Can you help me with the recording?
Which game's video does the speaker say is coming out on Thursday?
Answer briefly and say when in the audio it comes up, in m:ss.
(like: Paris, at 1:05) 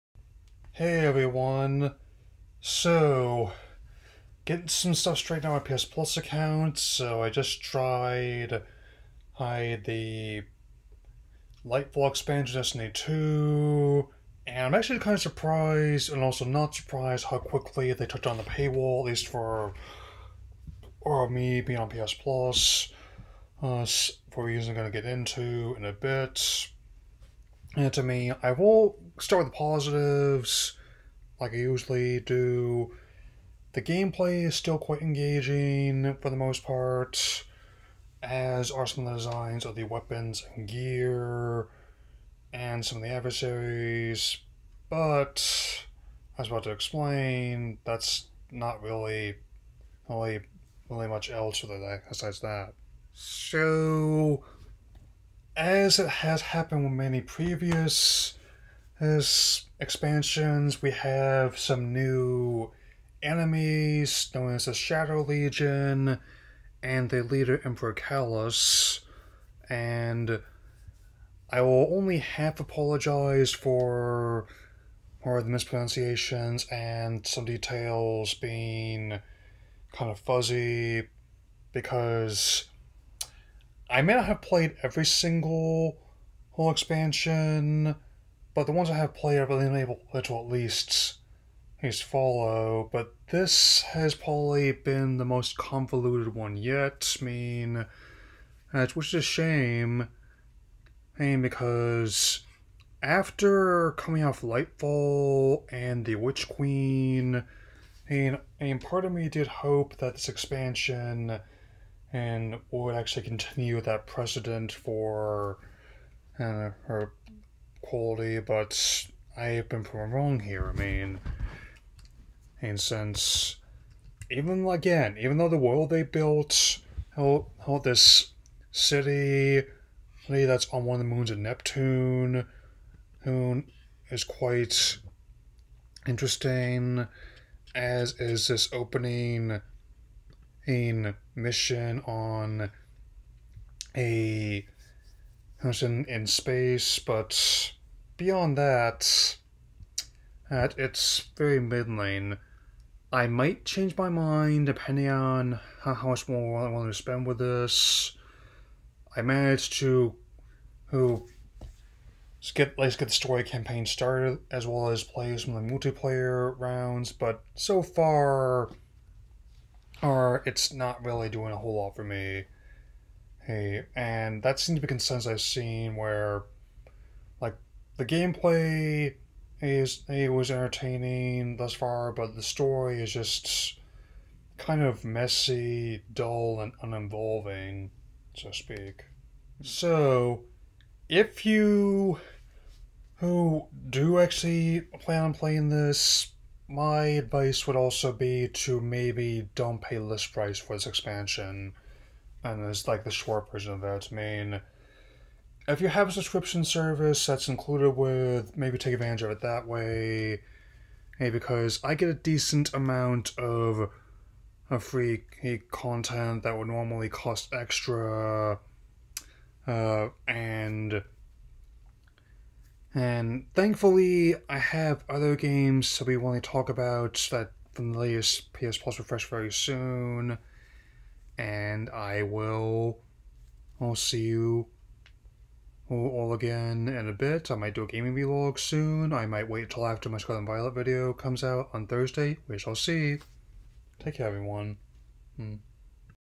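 Scarlet Violet, at 4:00.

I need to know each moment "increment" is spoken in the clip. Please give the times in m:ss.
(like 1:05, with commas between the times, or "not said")
not said.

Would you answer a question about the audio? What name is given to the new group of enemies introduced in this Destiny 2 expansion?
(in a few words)
Shadow Legion.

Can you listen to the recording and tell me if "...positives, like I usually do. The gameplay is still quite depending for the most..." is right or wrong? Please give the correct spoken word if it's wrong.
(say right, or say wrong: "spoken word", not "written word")
wrong: "engaging", not "depending".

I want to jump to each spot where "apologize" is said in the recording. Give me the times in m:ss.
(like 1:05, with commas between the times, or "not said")
1:12.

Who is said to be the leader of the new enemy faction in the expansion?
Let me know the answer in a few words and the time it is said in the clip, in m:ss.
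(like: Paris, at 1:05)
Emperor Calus, at 1:07.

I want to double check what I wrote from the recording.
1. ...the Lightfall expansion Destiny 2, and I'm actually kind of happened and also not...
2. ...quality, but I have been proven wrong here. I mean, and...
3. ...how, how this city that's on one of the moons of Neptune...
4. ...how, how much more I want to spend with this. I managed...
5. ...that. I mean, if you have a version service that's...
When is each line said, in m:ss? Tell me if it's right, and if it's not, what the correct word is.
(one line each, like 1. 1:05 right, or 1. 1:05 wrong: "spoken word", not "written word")
1. 0:09 wrong: "surprised", not "happened"
2. 1:57 right
3. 2:07 right
4. 2:35 right
5. 3:23 wrong: "subscription", not "version".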